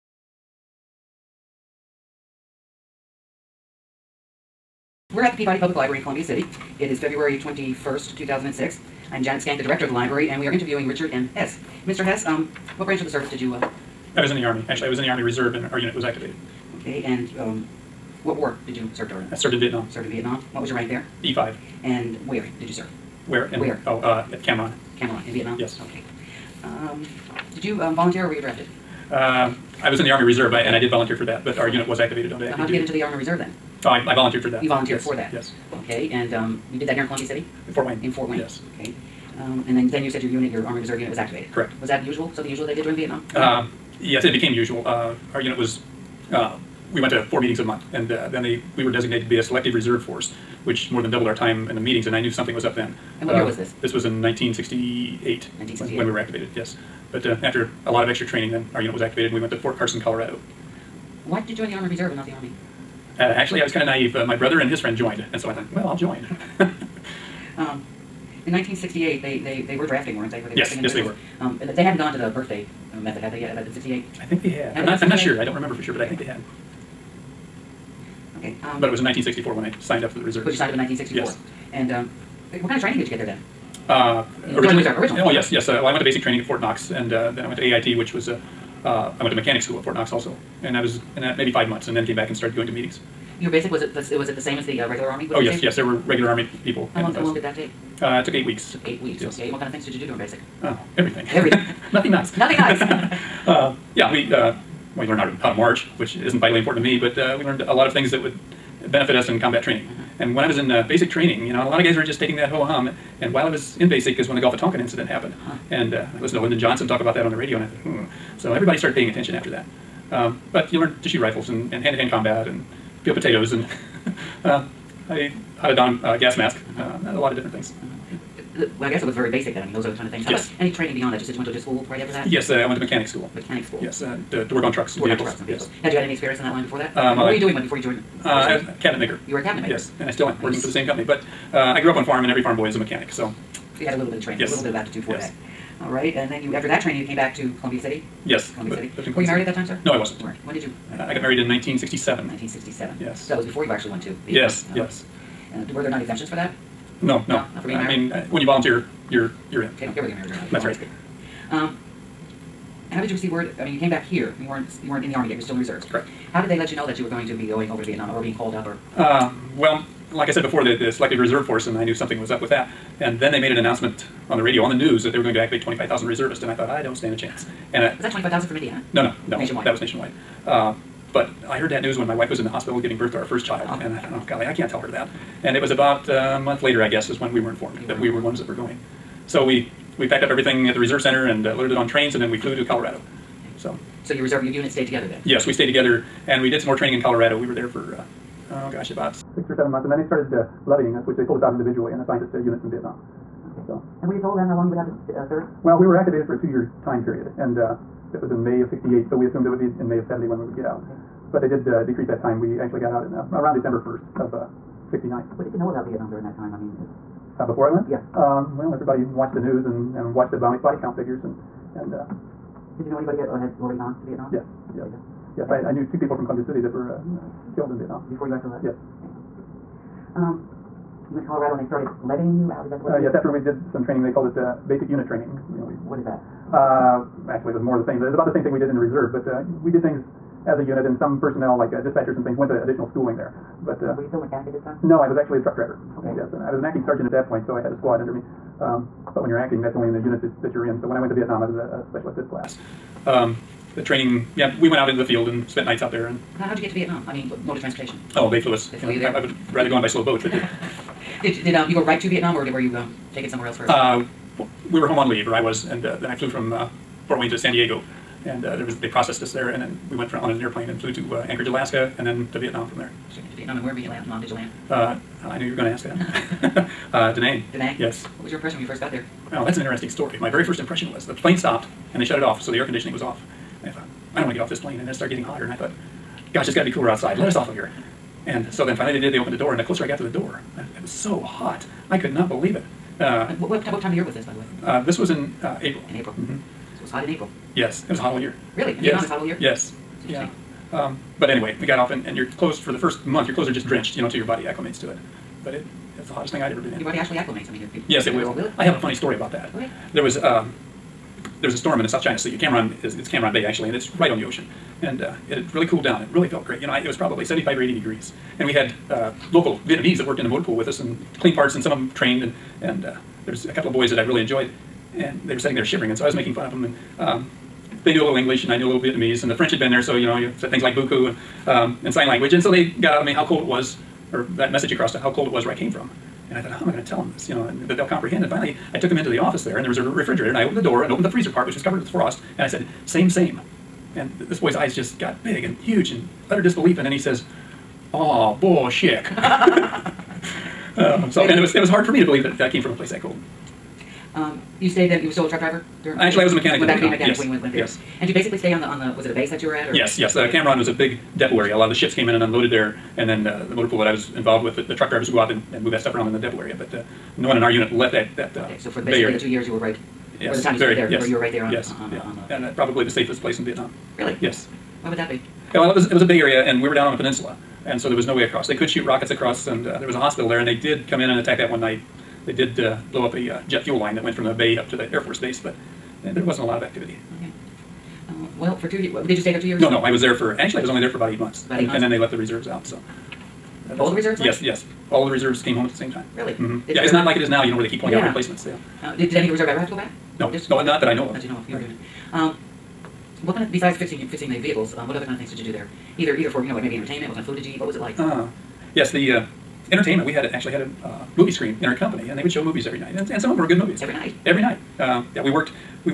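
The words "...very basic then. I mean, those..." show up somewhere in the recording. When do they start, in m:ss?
2:09.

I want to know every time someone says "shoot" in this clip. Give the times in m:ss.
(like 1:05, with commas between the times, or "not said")
2:01, 6:18.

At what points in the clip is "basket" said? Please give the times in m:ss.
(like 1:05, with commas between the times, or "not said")
not said.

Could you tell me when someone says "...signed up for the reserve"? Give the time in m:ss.
1:19.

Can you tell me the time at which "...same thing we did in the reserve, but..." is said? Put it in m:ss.
3:58.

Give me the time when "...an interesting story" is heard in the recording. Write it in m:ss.
4:39.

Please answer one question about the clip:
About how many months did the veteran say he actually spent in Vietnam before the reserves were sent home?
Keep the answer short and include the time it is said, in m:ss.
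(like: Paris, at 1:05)
8, at 6:31.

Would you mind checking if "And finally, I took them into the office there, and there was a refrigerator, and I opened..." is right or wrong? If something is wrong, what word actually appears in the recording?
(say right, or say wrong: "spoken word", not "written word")
right.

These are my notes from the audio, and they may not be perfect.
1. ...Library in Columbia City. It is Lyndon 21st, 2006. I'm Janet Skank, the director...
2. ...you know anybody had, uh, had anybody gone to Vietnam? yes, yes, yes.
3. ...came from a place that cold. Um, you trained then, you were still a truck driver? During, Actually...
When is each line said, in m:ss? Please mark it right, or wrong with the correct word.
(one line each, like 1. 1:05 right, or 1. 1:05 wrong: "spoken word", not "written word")
1. 0:05 wrong: "February", not "Lyndon"
2. 3:42 wrong: "already", not "anybody"
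3. 5:52 wrong: "stayed", not "trained".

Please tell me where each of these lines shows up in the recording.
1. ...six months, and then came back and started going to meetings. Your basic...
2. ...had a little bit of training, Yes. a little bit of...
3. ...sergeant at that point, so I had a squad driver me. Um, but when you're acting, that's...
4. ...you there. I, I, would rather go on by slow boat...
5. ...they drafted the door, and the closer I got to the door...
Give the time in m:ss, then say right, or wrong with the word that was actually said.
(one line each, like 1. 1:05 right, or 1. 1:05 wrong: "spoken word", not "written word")
1. 1:31 wrong: "five", not "six"
2. 2:23 right
3. 4:06 wrong: "under", not "driver"
4. 4:18 right
5. 4:49 wrong: "opened", not "drafted".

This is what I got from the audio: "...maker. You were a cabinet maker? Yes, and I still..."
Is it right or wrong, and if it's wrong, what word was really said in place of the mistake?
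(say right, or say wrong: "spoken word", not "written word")
right.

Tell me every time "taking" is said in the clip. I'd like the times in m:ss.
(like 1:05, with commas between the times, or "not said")
1:52.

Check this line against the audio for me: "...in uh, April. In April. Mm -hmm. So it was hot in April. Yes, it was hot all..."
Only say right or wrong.
right.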